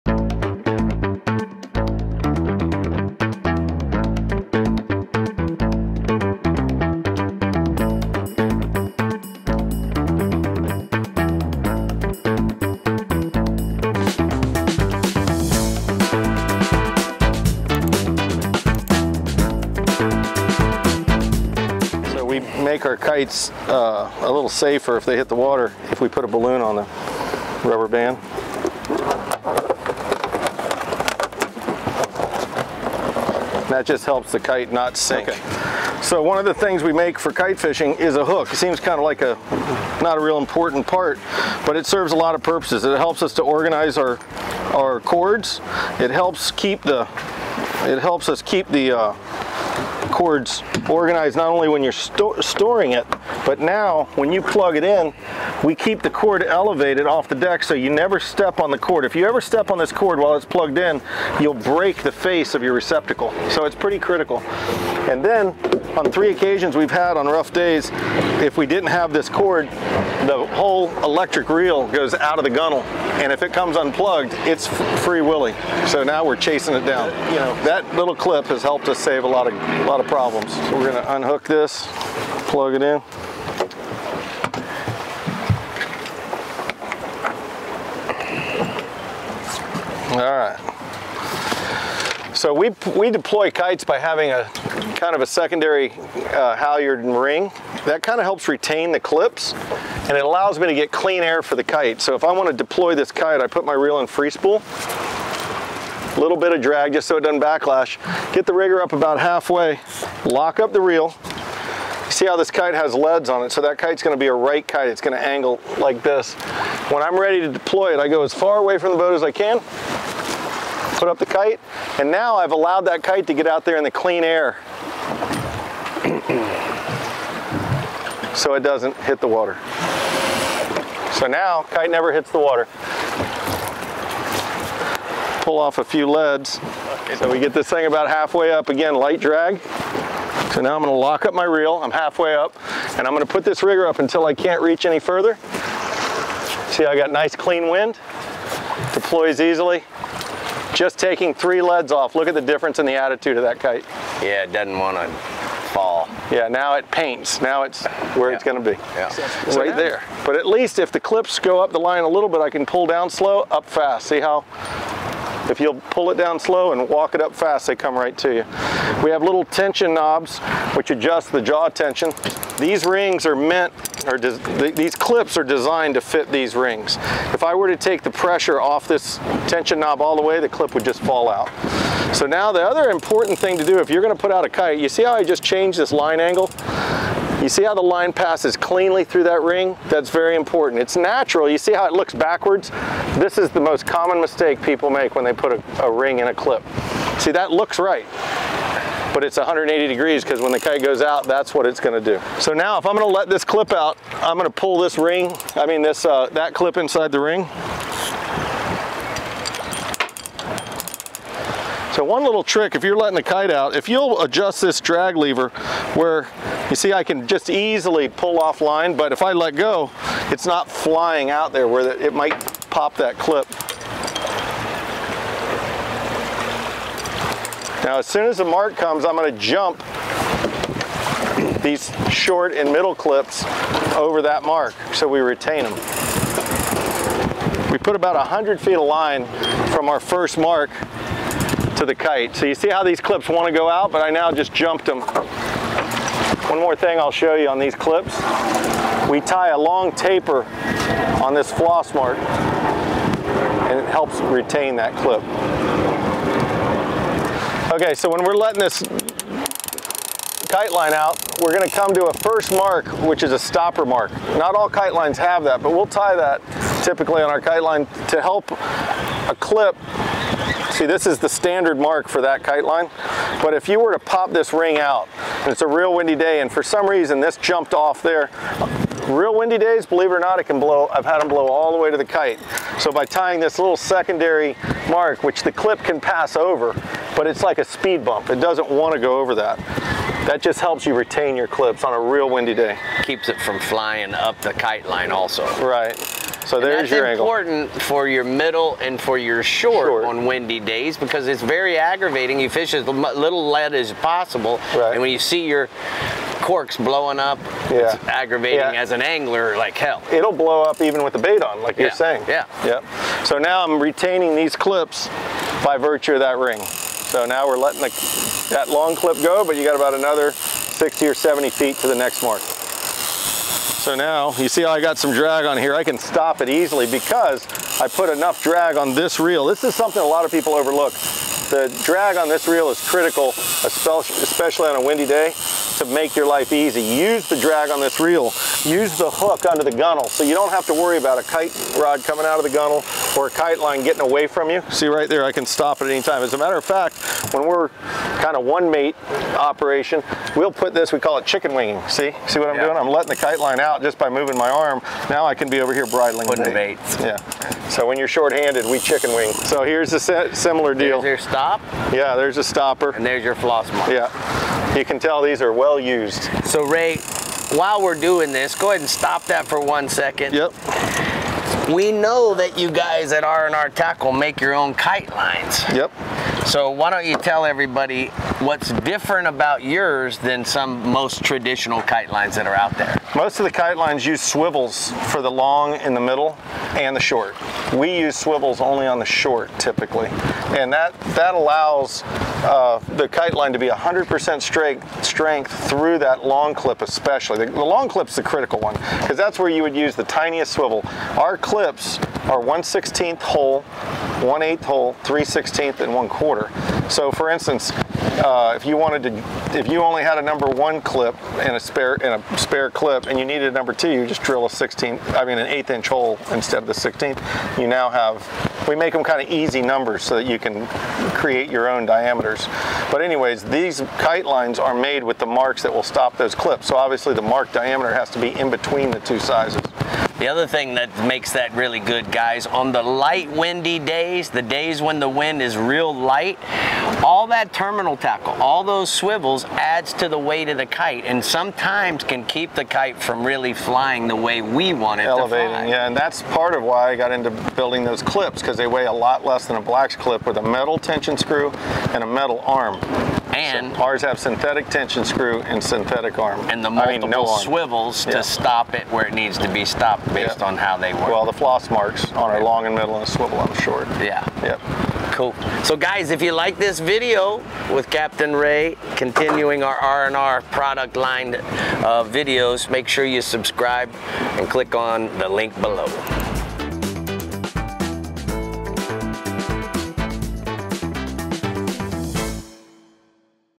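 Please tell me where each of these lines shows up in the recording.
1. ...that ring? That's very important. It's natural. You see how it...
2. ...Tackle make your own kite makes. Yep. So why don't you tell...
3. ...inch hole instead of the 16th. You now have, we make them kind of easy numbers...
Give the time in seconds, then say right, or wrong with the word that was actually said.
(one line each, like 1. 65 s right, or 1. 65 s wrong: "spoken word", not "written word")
1. 189 s right
2. 373 s wrong: "lines", not "makes"
3. 415 s right.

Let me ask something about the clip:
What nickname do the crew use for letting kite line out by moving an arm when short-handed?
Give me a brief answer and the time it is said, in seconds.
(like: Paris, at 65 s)
chicken winging, at 351 s.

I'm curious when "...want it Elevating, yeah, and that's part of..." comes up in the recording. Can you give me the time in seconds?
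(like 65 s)
444 s.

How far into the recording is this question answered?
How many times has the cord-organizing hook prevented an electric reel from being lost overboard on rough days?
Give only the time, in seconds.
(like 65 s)
66 s.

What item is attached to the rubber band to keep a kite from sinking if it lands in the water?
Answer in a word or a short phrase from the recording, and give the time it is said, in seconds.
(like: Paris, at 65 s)
balloon, at 26 s.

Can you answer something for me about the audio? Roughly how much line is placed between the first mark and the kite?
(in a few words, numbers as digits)
100 feet.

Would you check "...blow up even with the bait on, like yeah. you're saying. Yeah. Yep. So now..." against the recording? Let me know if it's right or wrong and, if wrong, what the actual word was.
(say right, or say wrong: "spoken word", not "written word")
right.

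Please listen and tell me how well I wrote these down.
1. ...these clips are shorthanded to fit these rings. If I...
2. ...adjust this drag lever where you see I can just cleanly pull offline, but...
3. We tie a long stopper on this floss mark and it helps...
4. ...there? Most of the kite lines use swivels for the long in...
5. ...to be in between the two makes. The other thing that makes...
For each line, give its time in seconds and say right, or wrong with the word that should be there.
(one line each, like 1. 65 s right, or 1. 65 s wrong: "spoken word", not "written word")
1. 174 s wrong: "designed", not "shorthanded"
2. 214 s wrong: "easily", not "cleanly"
3. 249 s wrong: "taper", not "stopper"
4. 382 s right
5. 428 s wrong: "sizes", not "makes".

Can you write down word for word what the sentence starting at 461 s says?
Well, the floss marks on our long and middle and swivel on the short.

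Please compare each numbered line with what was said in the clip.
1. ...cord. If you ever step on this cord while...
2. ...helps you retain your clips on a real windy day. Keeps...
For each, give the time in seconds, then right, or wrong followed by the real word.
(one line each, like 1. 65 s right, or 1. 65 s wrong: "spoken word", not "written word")
1. 58 s right
2. 290 s right.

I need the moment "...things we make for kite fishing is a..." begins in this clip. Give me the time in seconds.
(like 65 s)
36 s.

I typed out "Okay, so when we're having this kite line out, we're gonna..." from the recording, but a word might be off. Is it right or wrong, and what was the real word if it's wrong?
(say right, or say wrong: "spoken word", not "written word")
wrong: "letting", not "having".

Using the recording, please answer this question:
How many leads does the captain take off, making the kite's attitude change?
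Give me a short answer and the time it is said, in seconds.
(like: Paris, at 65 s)
3, at 151 s.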